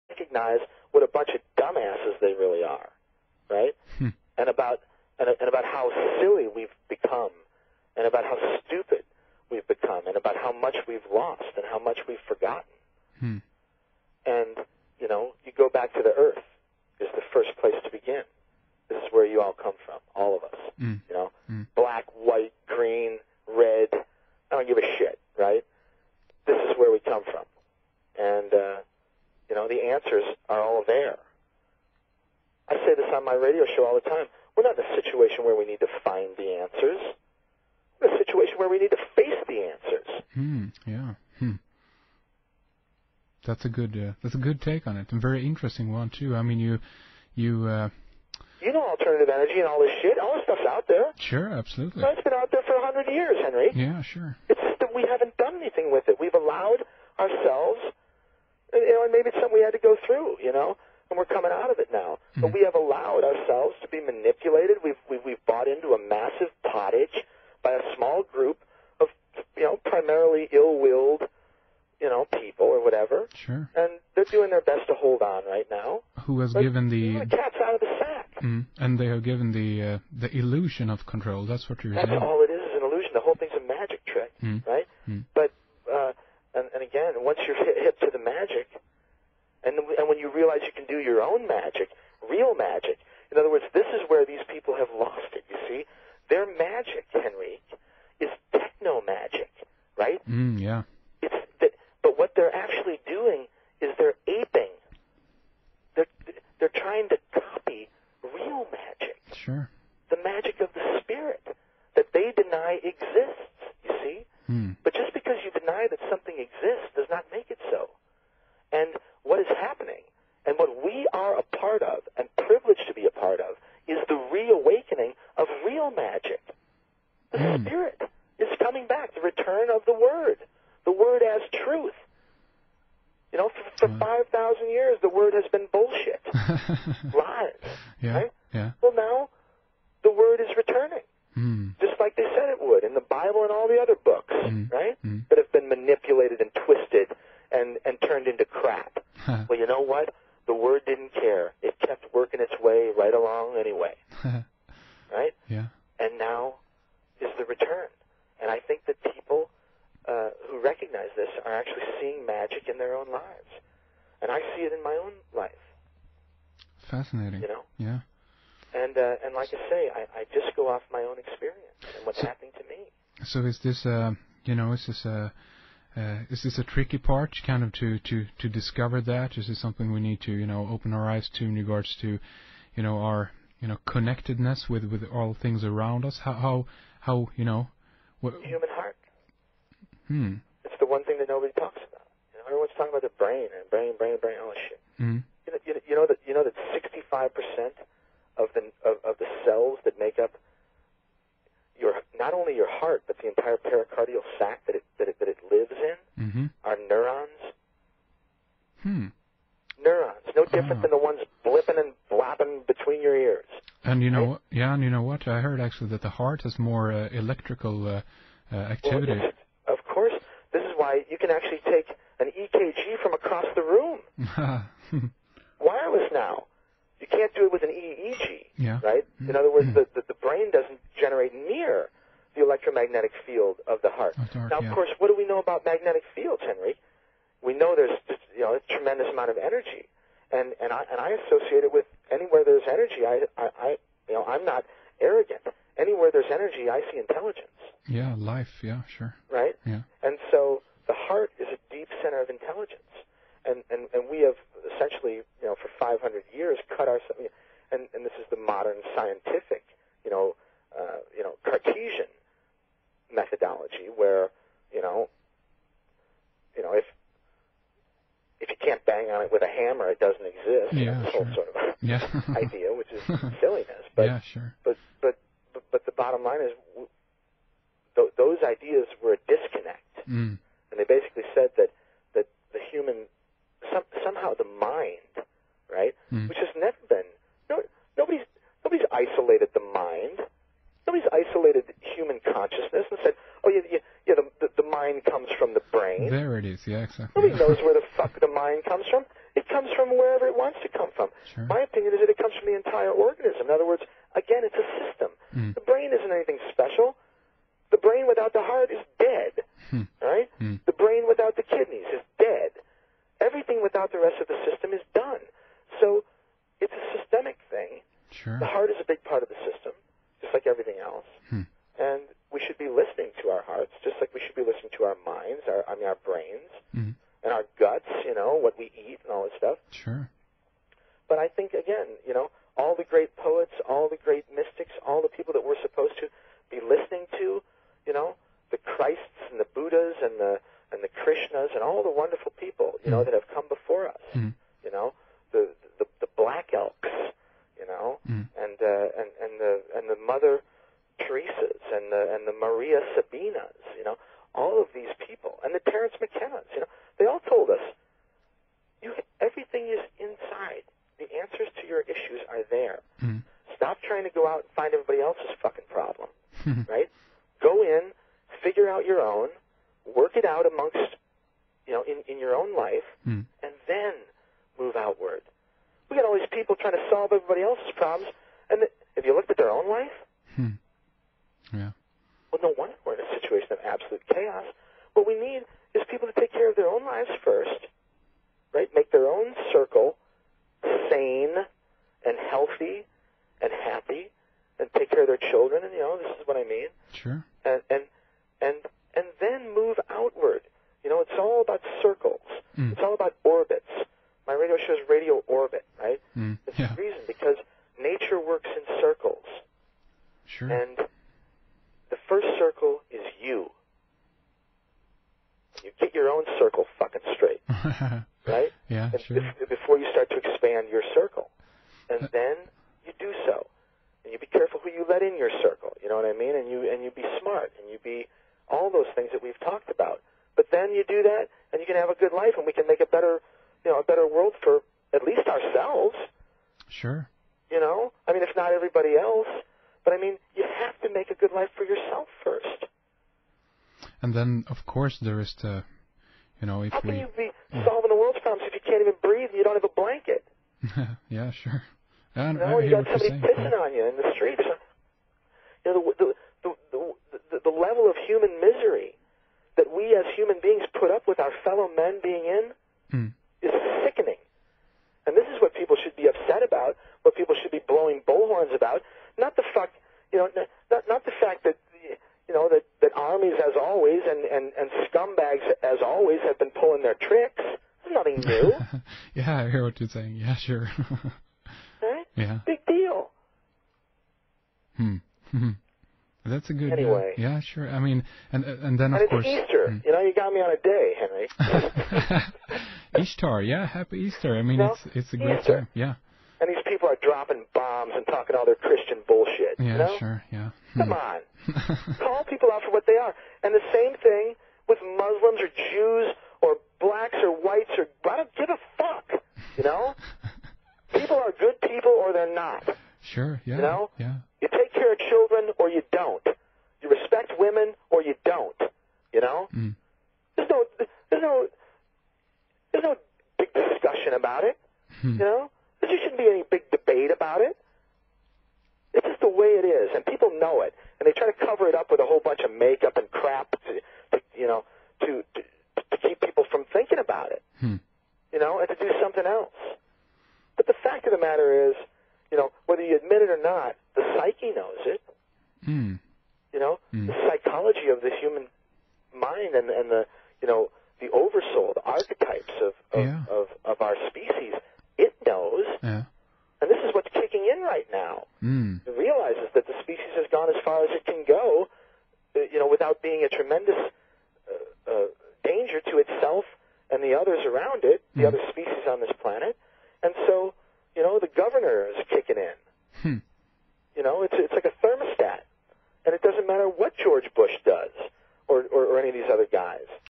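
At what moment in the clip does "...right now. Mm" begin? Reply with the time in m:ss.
9:17.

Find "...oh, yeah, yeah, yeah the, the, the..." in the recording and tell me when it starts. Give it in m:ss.
4:53.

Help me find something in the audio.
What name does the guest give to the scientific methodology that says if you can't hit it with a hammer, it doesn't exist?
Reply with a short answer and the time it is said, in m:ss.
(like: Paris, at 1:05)
Cartesian methodology, at 4:21.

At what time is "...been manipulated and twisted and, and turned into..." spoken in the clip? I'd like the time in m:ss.
2:25.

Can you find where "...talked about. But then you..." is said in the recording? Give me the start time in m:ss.
7:09.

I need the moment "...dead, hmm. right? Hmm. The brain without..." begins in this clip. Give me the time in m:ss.
5:08.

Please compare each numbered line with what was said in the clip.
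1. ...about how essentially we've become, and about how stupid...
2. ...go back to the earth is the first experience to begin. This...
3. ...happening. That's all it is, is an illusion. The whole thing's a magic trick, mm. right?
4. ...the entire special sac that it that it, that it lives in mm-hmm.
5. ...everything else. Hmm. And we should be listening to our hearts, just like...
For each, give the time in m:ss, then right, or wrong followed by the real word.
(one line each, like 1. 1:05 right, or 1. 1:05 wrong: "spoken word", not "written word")
1. 0:05 wrong: "silly", not "essentially"
2. 0:15 wrong: "place", not "experience"
3. 1:21 wrong: "saying", not "happening"
4. 3:23 wrong: "pericardial", not "special"
5. 5:20 right.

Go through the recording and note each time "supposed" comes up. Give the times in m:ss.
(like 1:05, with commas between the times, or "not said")
5:35.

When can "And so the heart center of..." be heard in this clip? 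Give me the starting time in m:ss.
4:10.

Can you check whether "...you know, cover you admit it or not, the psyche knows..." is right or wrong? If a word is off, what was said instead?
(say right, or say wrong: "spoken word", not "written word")
wrong: "whether", not "cover".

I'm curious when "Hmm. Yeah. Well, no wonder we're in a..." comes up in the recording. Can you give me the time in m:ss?
6:20.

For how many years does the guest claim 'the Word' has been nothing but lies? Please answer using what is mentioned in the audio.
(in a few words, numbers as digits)
5,000.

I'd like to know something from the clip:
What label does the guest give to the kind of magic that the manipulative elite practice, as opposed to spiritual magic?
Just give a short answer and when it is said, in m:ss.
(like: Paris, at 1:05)
techno magic, at 1:38.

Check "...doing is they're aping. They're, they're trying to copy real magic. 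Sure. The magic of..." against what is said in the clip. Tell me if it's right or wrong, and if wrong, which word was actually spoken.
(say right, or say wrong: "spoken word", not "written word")
right.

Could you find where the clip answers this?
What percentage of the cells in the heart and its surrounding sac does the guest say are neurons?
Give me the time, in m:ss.
3:16.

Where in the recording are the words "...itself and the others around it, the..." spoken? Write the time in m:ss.
9:25.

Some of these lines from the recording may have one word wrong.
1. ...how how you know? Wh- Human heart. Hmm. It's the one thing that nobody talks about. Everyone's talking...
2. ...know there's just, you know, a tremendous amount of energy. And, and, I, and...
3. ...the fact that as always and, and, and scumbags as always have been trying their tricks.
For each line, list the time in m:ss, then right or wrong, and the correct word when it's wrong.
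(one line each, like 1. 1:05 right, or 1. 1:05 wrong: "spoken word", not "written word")
1. 3:06 right
2. 3:57 right
3. 7:51 wrong: "pulling", not "trying".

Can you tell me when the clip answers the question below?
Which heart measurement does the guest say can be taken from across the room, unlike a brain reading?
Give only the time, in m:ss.
3:42.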